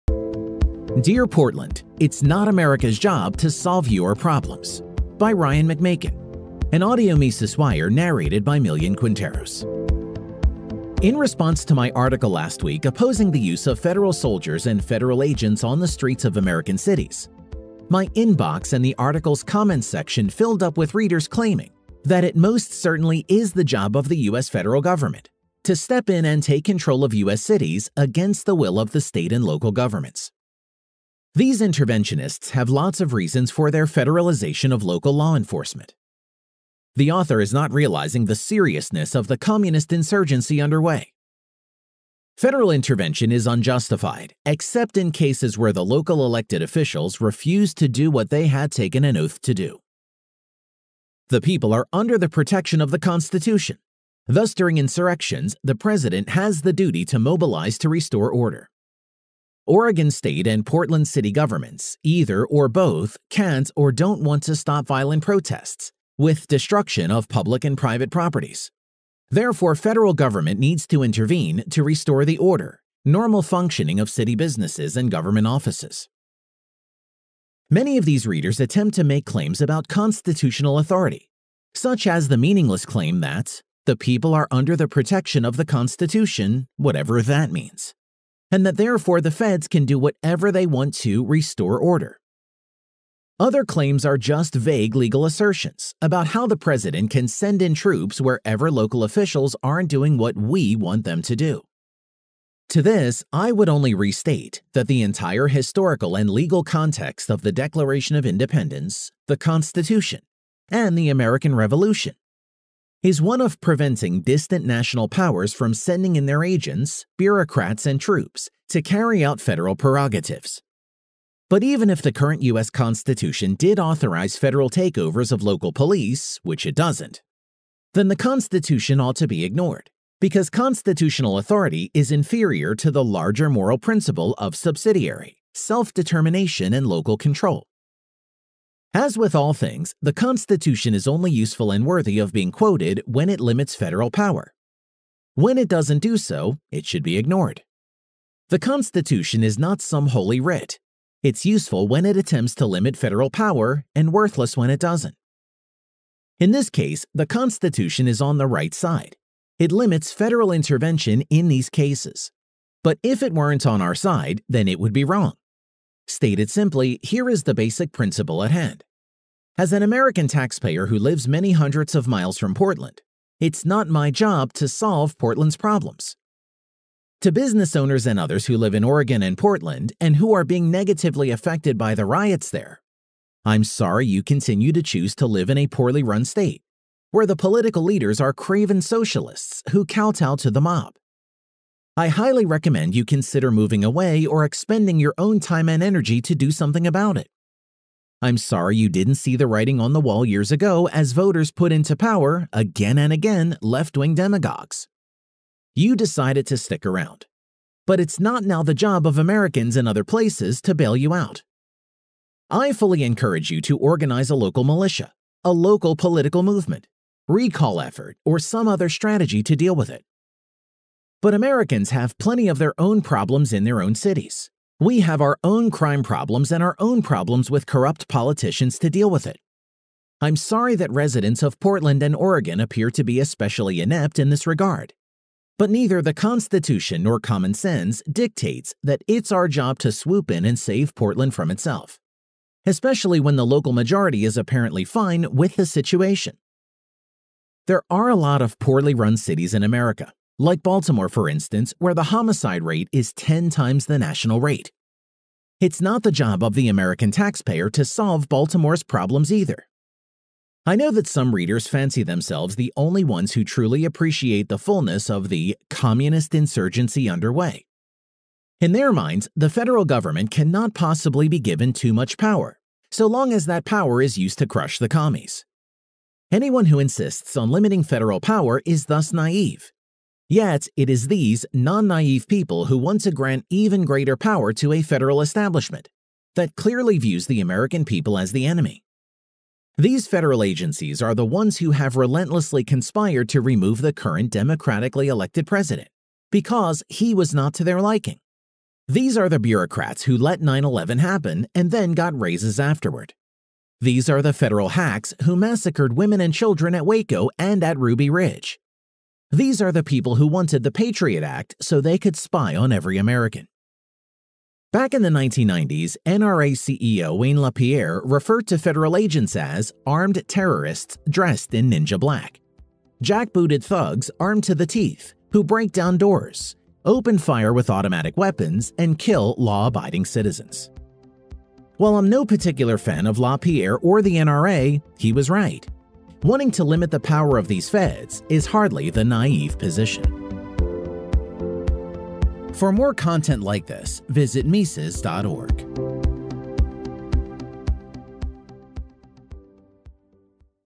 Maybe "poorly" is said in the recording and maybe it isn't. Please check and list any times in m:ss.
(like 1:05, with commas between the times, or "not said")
3:05, 4:08.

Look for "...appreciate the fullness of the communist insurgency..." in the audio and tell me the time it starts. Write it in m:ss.
4:23.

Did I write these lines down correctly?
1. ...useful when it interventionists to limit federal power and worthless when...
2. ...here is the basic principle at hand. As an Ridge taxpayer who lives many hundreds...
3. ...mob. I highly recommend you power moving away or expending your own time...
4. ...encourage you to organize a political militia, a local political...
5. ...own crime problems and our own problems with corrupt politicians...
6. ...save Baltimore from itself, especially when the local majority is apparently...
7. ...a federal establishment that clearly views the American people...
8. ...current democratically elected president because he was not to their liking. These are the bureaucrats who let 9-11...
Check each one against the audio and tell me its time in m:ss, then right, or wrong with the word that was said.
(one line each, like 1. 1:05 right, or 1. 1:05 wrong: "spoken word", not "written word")
1. 2:31 wrong: "attempts", not "interventionists"
2. 2:47 wrong: "American", not "Ridge"
3. 3:10 wrong: "consider", not "power"
4. 3:33 wrong: "local", not "political"
5. 3:45 right
6. 4:00 wrong: "Portland", not "Baltimore"
7. 4:44 right
8. 4:53 right.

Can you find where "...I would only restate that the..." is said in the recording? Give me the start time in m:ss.
1:43.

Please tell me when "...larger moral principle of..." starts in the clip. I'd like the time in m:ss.
2:13.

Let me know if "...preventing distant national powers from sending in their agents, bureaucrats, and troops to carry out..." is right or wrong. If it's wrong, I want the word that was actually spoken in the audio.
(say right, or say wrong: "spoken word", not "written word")
right.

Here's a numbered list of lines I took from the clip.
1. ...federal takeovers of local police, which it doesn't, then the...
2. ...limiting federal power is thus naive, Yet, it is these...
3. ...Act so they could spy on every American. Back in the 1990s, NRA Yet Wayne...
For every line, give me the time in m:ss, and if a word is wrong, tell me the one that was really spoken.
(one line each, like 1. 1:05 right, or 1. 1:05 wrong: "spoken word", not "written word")
1. 2:04 right
2. 4:37 right
3. 5:11 wrong: "CEO", not "Yet".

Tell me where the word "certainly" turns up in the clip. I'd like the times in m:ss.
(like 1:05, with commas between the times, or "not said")
0:22.